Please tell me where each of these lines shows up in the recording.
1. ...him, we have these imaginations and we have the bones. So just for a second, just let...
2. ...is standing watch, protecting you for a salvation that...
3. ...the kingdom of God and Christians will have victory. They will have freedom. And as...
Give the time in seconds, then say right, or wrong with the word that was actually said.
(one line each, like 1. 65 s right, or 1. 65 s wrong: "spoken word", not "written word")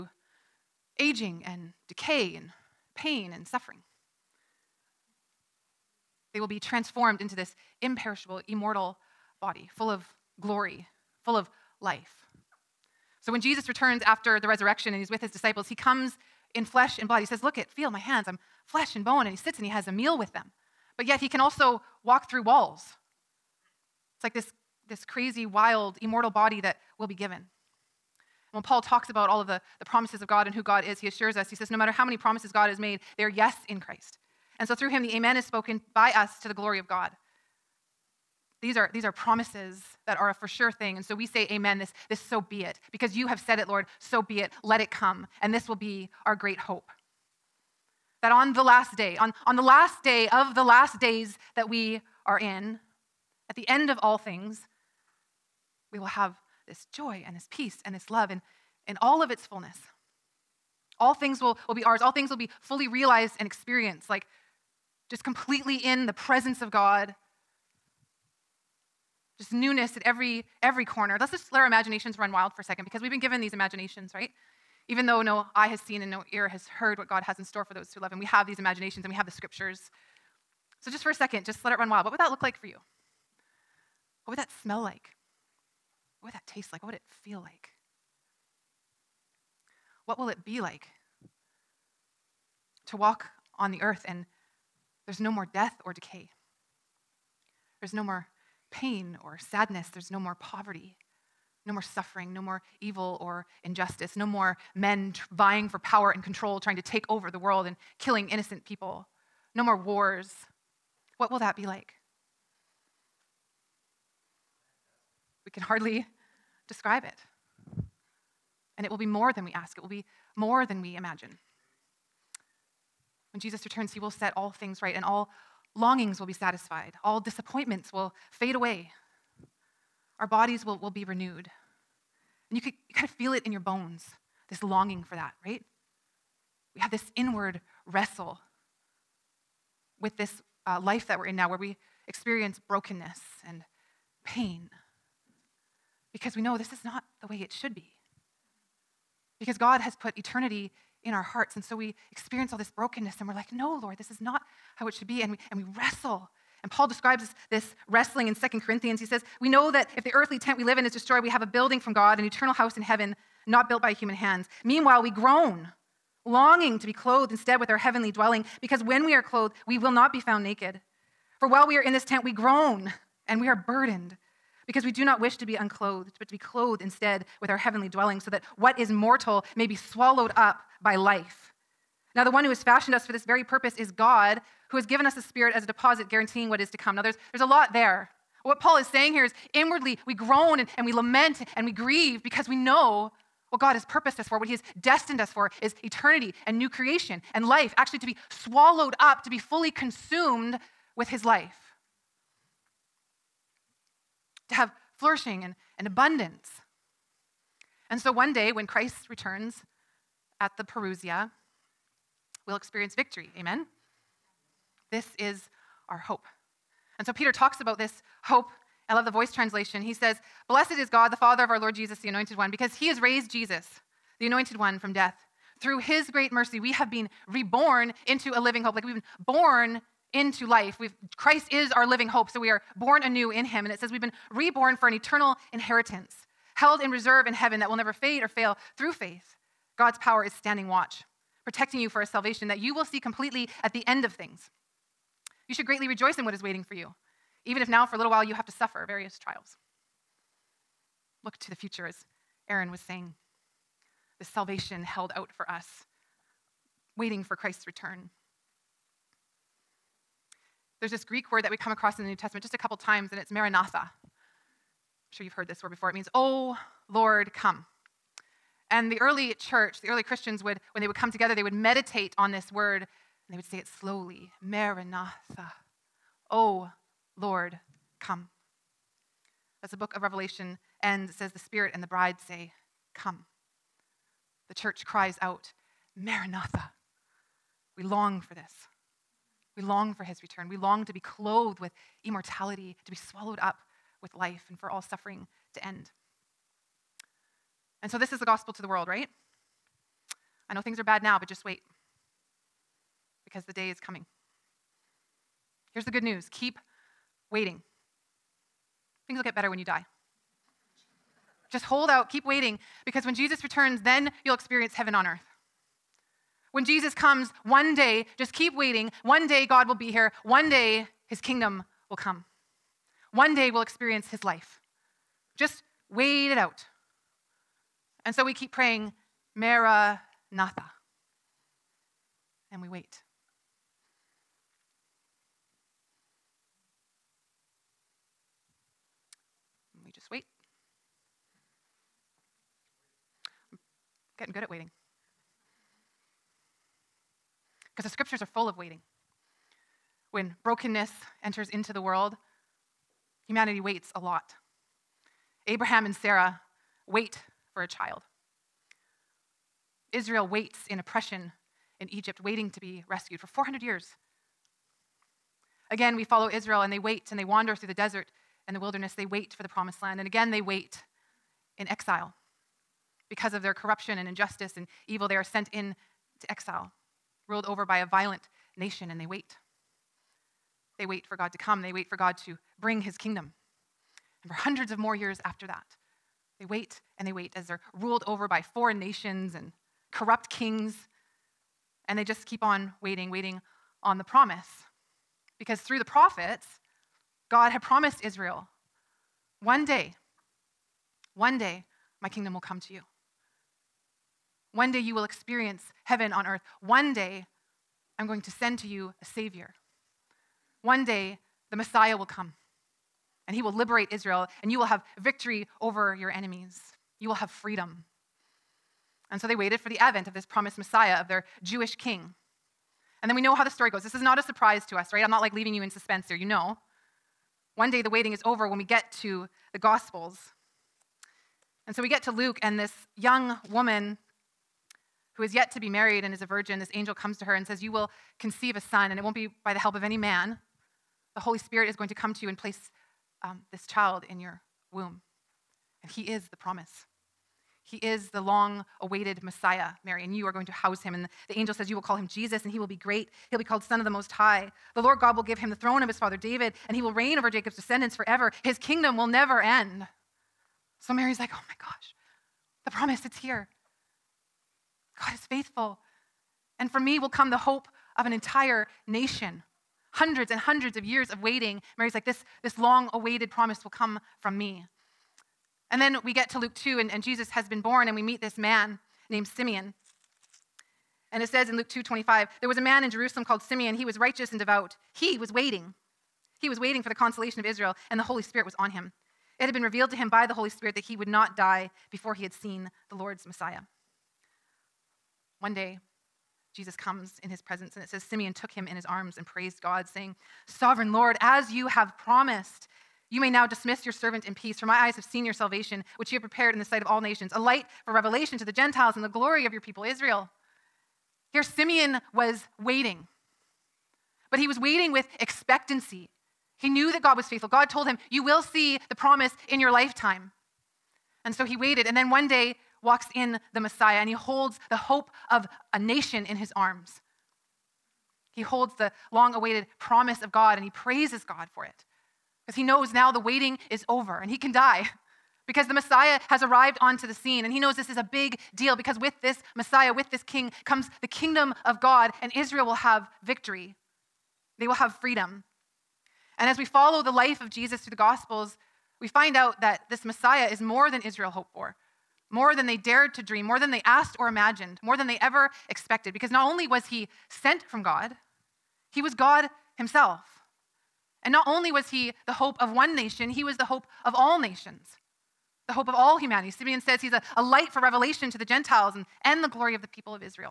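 1. 78 s wrong: "scriptures", not "bones"
2. 240 s right
3. 541 s wrong: "Israel", not "Christians".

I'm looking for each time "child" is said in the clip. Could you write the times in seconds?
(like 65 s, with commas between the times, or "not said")
357 s, 443 s.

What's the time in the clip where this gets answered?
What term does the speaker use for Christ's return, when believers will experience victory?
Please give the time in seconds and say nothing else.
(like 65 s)
210 s.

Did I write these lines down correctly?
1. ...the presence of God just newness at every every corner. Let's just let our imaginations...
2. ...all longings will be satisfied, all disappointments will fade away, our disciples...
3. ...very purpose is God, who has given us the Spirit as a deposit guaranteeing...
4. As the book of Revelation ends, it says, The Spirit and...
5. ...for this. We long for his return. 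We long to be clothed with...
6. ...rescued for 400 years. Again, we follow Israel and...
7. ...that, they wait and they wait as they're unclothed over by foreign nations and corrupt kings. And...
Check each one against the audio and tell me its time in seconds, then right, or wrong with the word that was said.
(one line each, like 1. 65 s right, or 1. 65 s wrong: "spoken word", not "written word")
1. 66 s right
2. 125 s wrong: "bodies", not "disciples"
3. 183 s right
4. 279 s right
5. 288 s right
6. 362 s right
7. 385 s wrong: "ruled", not "unclothed".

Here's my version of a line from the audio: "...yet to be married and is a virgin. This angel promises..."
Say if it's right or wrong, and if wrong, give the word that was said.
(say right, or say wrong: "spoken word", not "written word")
wrong: "comes", not "promises".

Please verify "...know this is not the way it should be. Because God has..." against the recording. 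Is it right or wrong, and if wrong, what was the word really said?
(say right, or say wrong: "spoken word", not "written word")
right.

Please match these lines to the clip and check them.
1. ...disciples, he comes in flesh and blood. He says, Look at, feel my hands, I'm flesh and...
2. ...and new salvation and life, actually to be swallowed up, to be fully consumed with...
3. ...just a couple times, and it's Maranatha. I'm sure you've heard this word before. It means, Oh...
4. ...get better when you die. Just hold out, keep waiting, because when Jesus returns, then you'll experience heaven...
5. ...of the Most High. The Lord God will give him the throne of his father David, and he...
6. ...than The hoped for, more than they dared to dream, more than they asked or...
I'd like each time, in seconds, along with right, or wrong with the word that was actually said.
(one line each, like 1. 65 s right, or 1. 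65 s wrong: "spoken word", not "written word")
1. 15 s right
2. 196 s wrong: "creation", not "salvation"
3. 262 s right
4. 309 s right
5. 453 s right
6. 550 s wrong: "Israel", not "The".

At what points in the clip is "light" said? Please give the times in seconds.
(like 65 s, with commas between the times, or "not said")
507 s, 567 s.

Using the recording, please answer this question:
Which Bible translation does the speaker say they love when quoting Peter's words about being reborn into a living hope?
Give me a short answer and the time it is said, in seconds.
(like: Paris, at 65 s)
The Voice, at 219 s.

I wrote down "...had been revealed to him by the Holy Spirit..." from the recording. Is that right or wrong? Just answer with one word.
right.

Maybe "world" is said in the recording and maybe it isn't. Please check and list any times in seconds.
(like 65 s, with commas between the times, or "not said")
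107 s, 298 s, 351 s.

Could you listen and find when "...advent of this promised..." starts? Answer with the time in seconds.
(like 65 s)
419 s.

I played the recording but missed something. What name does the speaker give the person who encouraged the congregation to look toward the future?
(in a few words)
Aaron.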